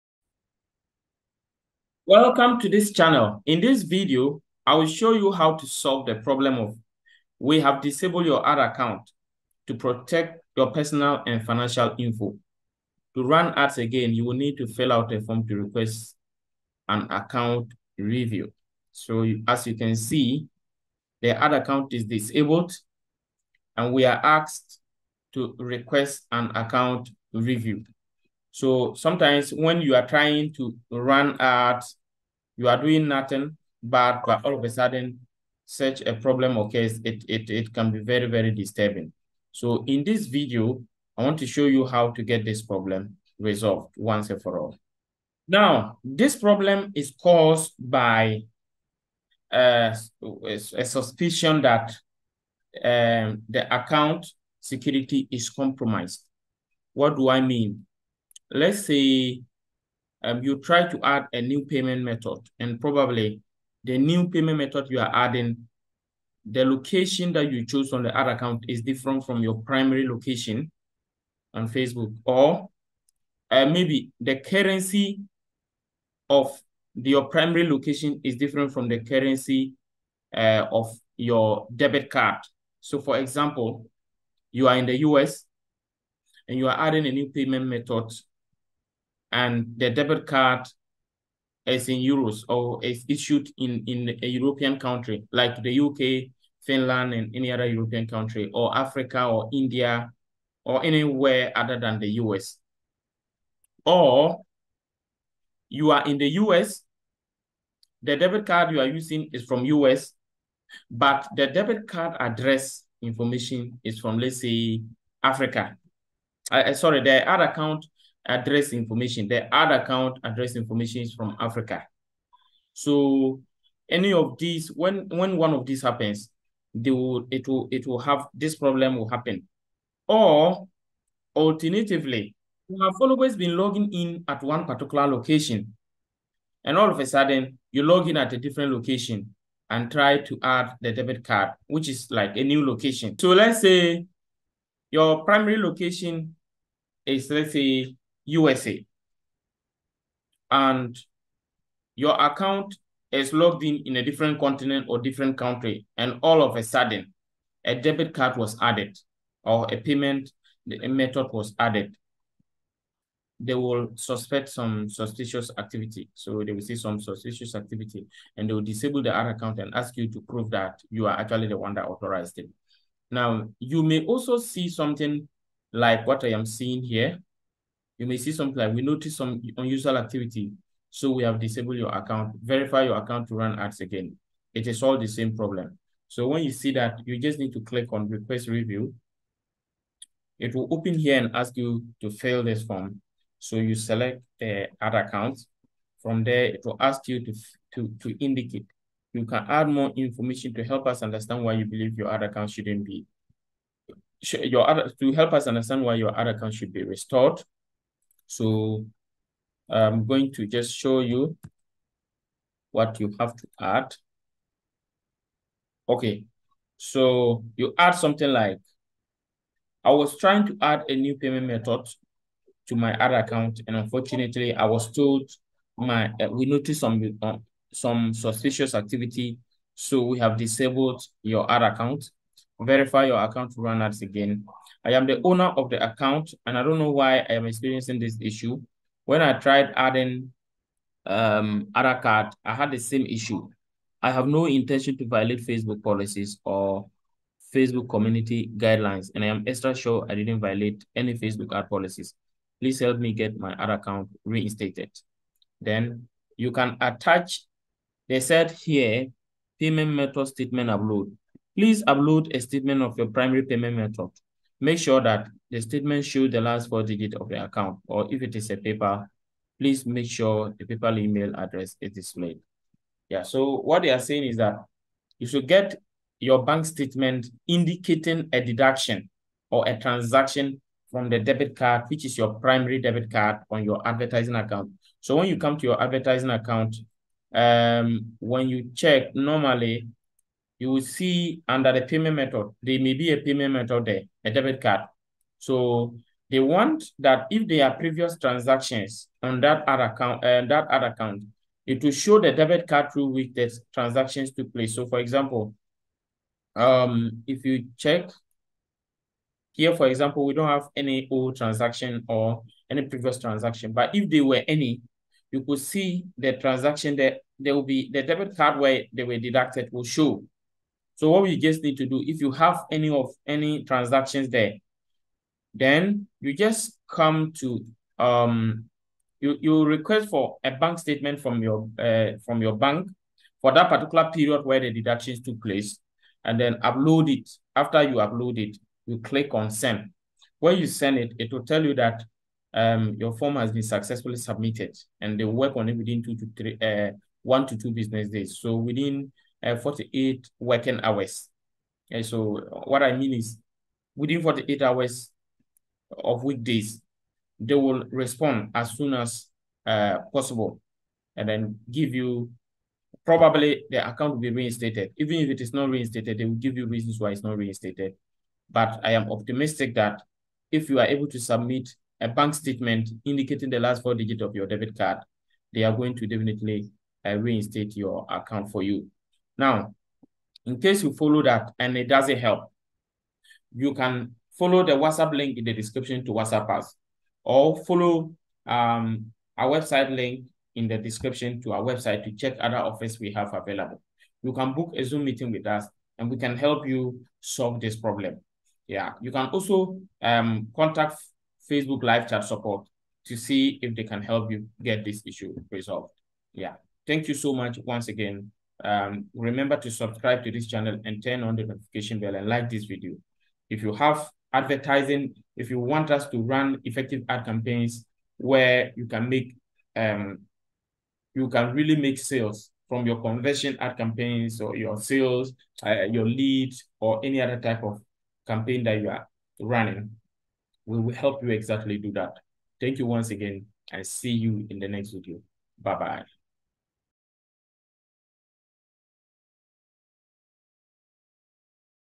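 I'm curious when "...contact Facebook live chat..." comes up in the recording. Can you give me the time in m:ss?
6:40.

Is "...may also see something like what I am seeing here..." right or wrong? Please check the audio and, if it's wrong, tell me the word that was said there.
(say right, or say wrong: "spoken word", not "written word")
right.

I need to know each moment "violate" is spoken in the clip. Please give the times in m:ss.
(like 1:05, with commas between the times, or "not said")
4:05, 4:10.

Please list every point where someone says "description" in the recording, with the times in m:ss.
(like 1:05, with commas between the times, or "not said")
6:25, 6:30.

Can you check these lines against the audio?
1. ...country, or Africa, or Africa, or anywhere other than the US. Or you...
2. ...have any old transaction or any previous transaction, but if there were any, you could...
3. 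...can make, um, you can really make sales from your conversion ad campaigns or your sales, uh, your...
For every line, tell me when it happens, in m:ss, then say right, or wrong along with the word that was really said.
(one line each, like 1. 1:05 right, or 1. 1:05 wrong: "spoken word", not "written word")
1. 1:38 wrong: "India", not "Africa"
2. 5:10 right
3. 6:58 right.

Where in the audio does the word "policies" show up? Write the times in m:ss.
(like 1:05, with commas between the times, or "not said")
4:05, 4:11.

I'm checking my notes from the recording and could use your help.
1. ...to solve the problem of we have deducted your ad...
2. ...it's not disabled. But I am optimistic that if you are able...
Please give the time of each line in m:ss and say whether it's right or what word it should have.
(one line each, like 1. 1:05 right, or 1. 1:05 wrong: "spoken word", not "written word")
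1. 0:05 wrong: "disabled", not "deducted"
2. 6:07 wrong: "reinstated", not "disabled".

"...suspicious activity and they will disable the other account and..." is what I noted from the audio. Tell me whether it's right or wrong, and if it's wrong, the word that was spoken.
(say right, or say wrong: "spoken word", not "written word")
right.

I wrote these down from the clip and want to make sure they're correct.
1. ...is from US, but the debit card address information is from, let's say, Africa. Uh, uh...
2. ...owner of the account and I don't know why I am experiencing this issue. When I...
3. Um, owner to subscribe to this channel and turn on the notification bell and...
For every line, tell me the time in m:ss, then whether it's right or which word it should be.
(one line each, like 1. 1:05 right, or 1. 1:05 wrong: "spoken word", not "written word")
1. 1:49 right
2. 3:55 right
3. 6:48 wrong: "remember", not "owner".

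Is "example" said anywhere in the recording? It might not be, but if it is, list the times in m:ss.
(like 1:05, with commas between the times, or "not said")
1:23, 5:04, 5:09.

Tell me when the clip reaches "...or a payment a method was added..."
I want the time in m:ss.
2:39.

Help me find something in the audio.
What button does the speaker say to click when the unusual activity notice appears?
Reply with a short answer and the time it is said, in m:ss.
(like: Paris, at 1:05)
request review, at 3:08.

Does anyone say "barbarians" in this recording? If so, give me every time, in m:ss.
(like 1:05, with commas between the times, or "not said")
not said.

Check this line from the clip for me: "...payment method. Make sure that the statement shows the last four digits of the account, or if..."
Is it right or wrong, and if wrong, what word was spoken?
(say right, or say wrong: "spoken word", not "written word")
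right.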